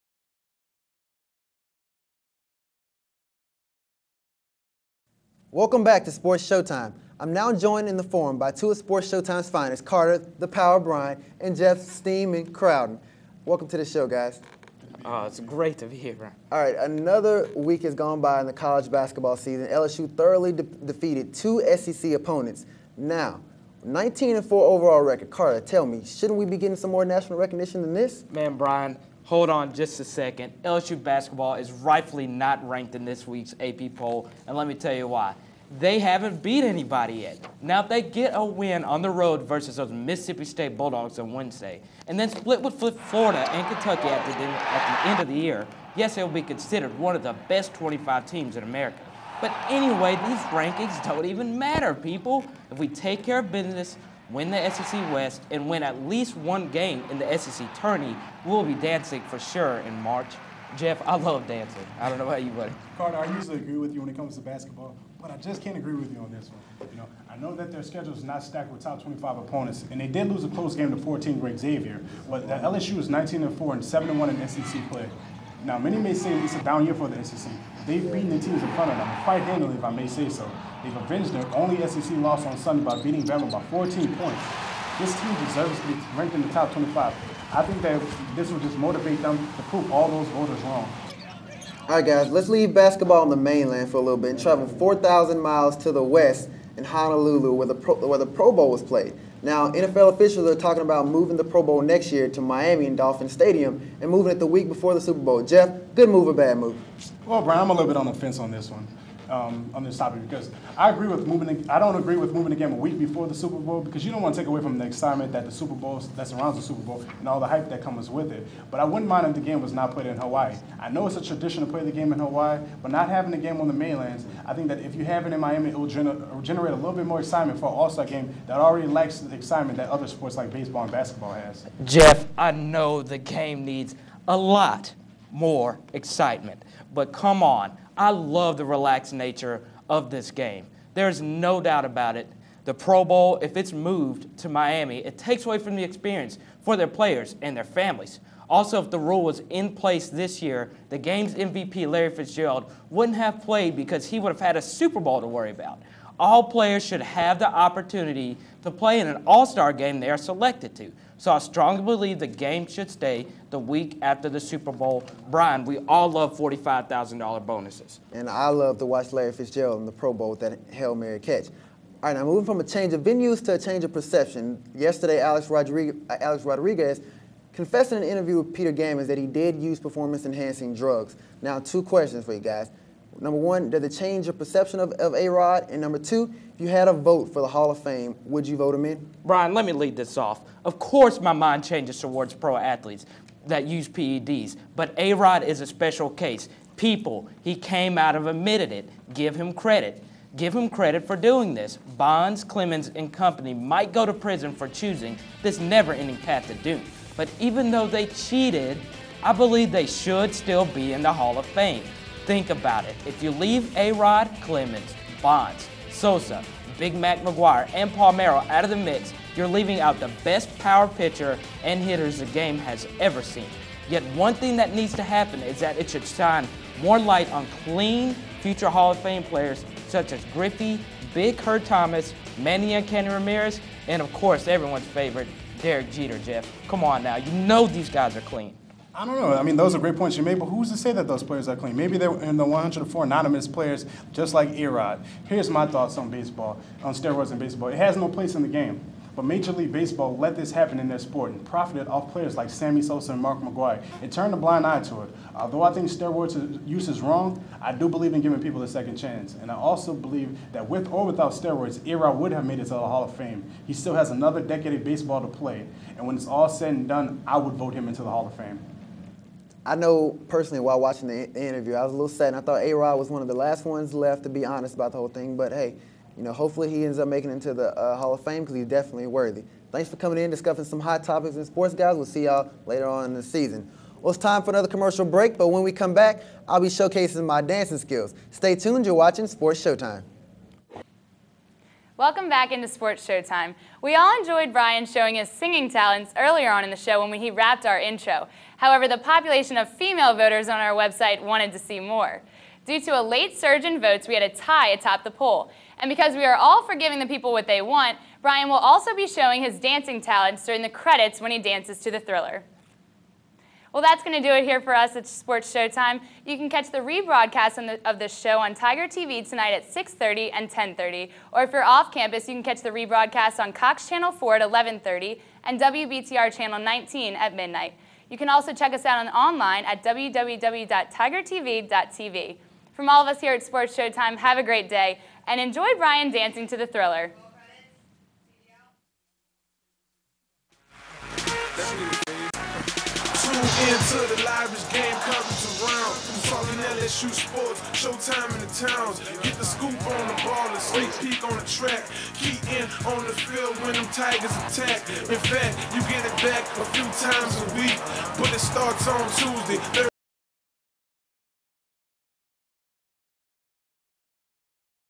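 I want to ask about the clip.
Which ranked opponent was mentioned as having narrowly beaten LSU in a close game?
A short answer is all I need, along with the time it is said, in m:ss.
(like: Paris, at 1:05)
Xavier, at 1:11.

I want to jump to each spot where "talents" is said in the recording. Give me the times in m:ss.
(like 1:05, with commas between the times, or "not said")
4:55, 5:10.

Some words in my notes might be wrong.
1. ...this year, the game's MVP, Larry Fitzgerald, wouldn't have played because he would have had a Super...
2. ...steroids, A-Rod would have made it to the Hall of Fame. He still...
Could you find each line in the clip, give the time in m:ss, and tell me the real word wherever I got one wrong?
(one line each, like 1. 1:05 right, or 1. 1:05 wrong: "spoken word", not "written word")
1. 2:30 right
2. 4:21 right.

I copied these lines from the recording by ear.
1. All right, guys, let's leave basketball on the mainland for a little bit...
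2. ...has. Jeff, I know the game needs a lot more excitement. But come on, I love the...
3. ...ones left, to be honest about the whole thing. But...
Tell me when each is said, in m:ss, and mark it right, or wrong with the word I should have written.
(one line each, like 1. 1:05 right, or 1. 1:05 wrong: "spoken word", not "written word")
1. 1:31 right
2. 2:11 right
3. 4:33 right.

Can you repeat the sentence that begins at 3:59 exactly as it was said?
I mean, those are great points you made, but who's to say that those players are clean?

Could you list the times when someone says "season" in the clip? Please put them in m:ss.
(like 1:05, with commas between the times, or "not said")
0:19, 4:43.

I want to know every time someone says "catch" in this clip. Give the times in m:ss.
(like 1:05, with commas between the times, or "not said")
2:51, 5:16, 5:22.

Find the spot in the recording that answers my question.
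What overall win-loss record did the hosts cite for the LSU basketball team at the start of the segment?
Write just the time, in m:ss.
0:23.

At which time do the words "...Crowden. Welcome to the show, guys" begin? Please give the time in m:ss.
0:12.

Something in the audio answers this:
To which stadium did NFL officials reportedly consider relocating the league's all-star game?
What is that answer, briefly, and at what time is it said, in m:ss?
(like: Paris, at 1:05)
Dolphin Stadium, at 1:42.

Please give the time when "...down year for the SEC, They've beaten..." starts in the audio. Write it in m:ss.
1:16.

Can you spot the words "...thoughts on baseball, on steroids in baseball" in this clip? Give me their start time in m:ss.
4:05.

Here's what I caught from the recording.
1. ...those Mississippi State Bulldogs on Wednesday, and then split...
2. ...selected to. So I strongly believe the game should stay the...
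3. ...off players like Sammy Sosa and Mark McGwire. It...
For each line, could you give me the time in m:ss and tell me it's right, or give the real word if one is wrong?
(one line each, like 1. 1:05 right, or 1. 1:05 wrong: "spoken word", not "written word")
1. 0:39 right
2. 2:40 right
3. 4:11 right.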